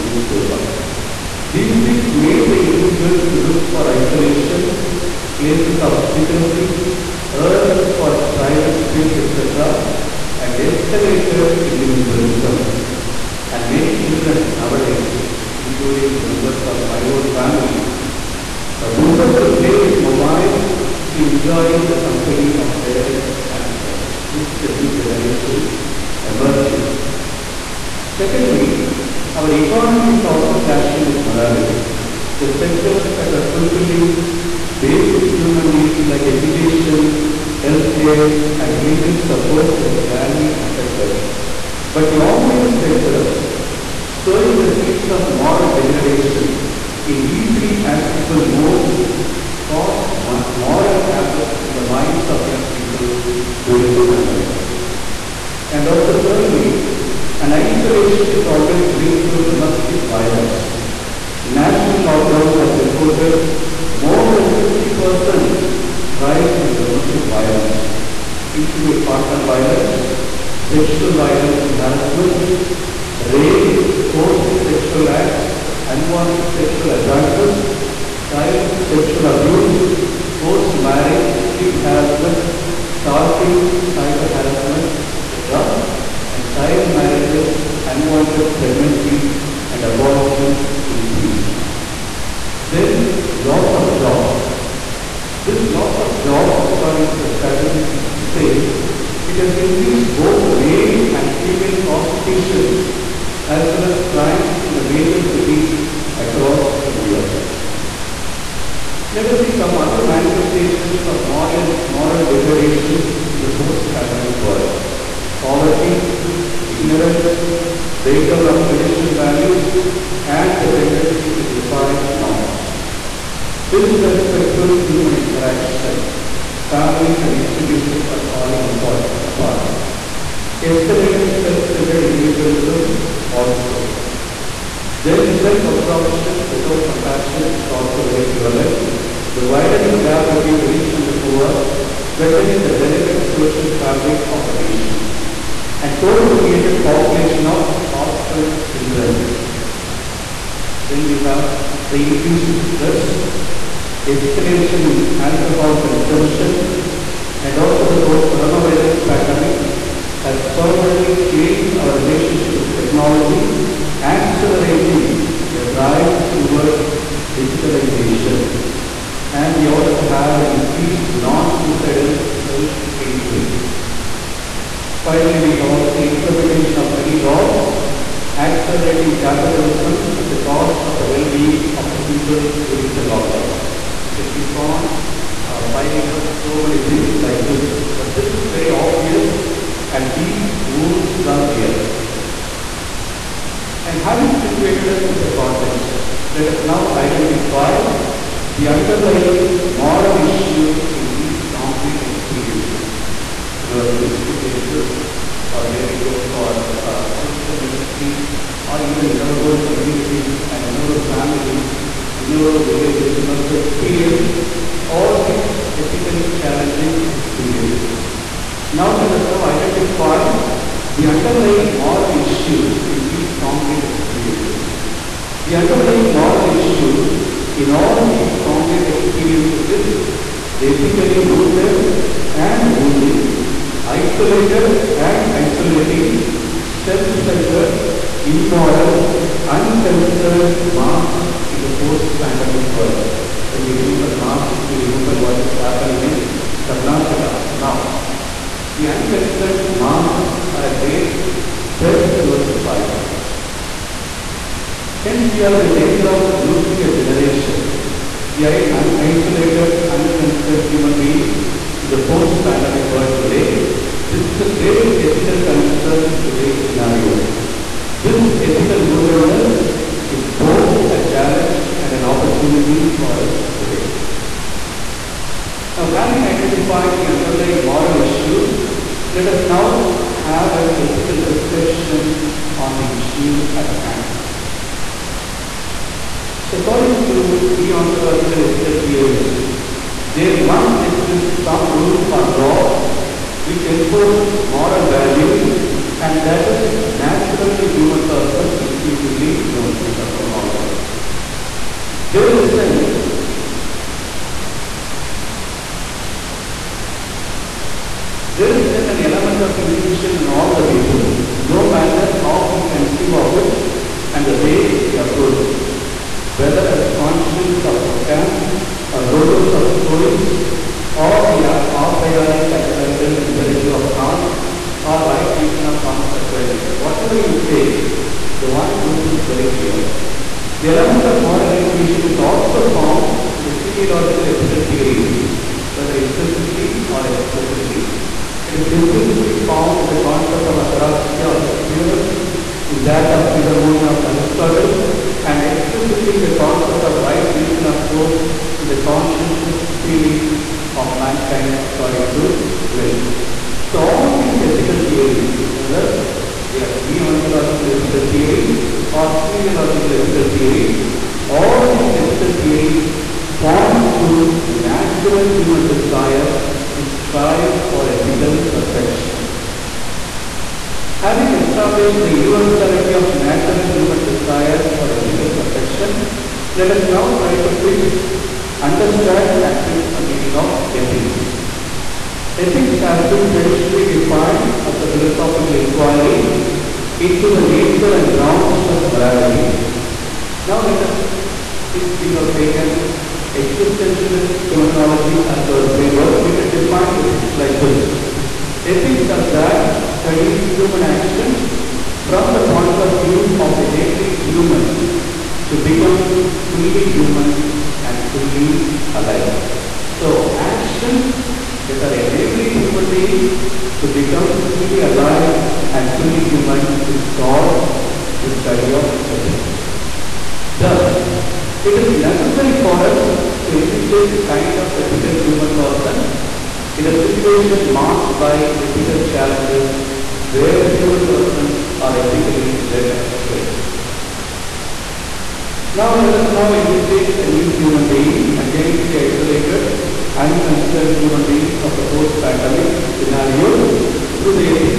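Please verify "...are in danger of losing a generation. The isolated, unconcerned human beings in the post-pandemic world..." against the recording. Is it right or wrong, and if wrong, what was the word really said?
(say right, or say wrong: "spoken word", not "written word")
right.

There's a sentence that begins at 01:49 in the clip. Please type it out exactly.
Let us see some other manifestations of moral, moral degradations in the post-pandemic world.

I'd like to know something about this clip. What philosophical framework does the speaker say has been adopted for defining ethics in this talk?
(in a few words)
existentialist phenomenology.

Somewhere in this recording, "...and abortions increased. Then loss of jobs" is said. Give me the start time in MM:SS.
01:29.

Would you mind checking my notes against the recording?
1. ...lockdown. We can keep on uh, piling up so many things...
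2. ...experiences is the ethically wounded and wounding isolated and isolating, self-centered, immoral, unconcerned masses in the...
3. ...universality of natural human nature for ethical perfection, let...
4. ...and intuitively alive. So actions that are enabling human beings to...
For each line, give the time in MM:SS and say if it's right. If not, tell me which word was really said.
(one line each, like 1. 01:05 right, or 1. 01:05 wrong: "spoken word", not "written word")
1. 03:03 right
2. 03:48 right
3. 06:12 wrong: "desire", not "nature"
4. 06:47 wrong: "fully", not "intuitively".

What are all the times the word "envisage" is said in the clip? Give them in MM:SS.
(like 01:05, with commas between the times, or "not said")
07:03, 07:16.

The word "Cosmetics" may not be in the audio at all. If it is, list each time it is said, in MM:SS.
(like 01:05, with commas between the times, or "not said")
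not said.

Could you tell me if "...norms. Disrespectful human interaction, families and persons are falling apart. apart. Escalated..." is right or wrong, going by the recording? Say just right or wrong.
wrong.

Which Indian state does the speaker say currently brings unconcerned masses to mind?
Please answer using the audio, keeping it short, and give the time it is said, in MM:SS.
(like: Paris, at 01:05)
Karnataka, at 04:06.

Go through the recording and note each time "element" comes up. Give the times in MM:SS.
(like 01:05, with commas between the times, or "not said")
05:09, 05:30.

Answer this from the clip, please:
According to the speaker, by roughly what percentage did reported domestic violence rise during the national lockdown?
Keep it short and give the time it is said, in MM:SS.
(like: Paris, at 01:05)
more than 50%, at 01:03.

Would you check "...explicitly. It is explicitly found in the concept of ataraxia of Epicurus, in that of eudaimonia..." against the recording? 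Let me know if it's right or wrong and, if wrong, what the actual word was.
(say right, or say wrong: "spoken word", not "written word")
wrong: "implicitly", not "explicitly".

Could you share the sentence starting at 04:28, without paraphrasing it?
This ethical vulnerableness is both a challenge and an opportunity for us today.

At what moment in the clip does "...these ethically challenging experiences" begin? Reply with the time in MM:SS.
03:35.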